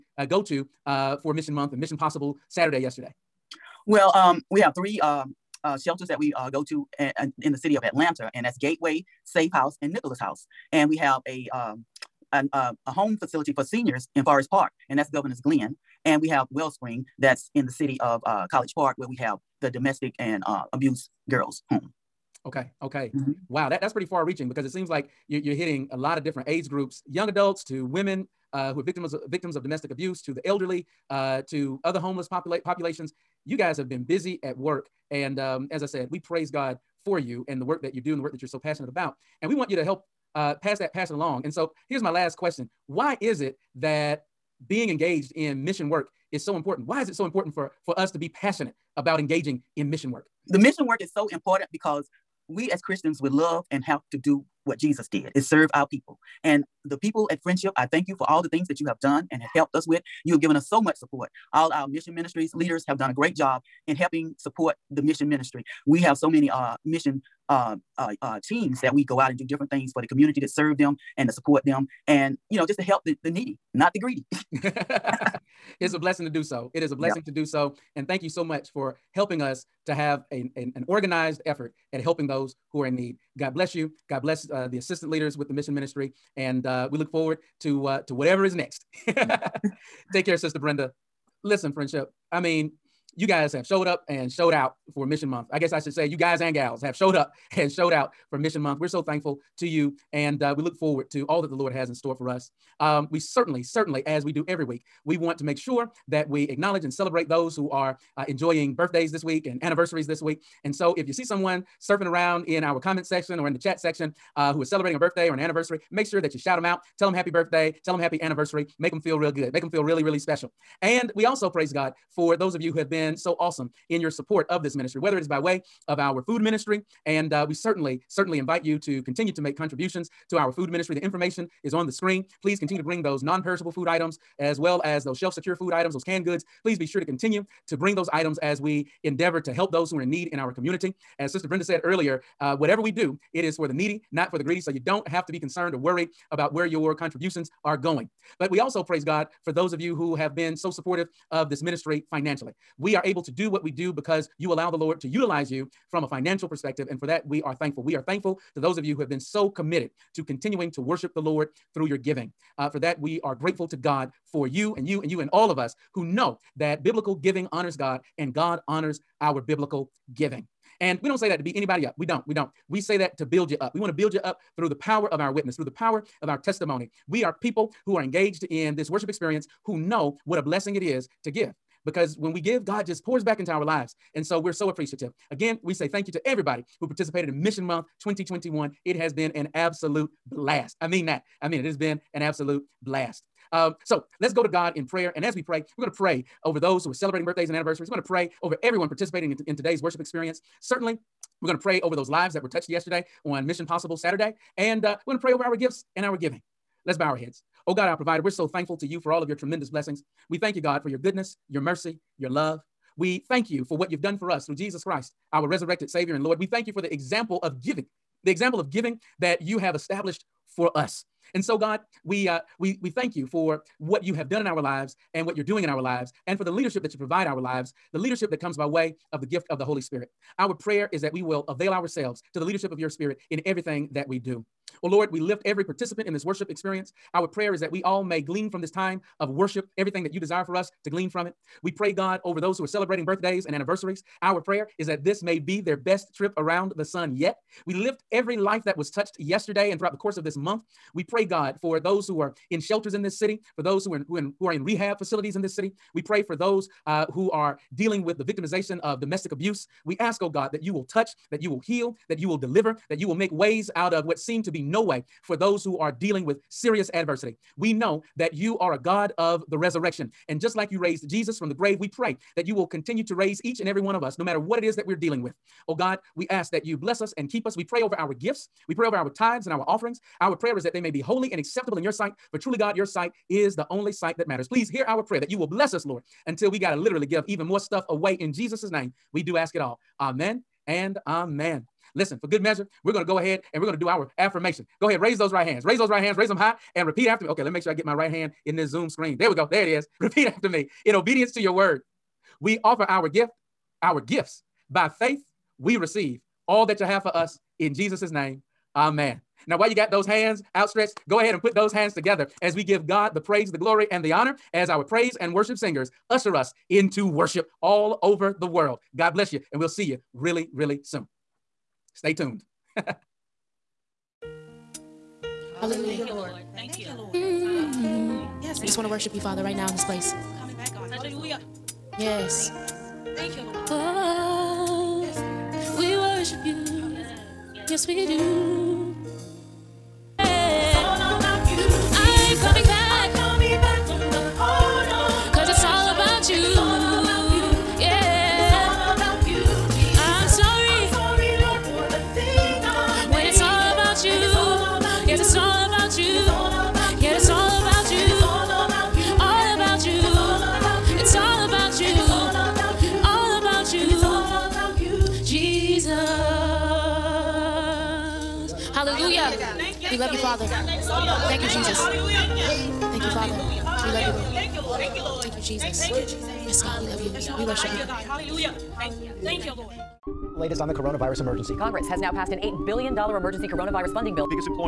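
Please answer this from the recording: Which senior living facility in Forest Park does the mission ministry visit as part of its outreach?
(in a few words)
Governor's Glen.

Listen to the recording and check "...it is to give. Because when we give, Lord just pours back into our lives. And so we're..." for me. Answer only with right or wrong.
wrong.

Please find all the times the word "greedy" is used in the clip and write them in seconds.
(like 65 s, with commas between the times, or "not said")
73 s, 144 s.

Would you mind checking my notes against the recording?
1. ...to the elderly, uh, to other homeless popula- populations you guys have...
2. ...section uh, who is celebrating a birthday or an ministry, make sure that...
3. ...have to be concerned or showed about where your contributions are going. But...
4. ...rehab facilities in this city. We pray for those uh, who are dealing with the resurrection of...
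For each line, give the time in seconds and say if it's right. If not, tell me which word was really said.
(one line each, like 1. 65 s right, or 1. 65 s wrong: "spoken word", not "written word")
1. 30 s right
2. 113 s wrong: "anniversary", not "ministry"
3. 145 s wrong: "worried", not "showed"
4. 254 s wrong: "victimization", not "resurrection".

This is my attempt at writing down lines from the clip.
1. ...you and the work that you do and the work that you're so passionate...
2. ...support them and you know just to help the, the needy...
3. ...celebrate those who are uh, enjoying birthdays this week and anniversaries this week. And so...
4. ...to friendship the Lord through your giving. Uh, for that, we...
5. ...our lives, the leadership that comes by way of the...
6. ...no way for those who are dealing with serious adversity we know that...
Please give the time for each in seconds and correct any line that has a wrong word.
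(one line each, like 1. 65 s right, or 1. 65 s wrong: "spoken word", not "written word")
1. 37 s right
2. 71 s right
3. 106 s right
4. 160 s wrong: "worship", not "friendship"
5. 227 s right
6. 264 s right.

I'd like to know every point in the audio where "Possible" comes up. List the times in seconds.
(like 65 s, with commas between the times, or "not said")
1 s, 203 s.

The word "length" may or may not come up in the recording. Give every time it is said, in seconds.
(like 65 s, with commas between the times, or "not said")
not said.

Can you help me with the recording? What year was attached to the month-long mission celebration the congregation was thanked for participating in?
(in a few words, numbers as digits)
2021.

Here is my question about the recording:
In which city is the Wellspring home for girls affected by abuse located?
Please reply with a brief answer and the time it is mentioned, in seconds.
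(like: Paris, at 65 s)
College Park, at 18 s.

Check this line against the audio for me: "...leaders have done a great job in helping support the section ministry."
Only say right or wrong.
wrong.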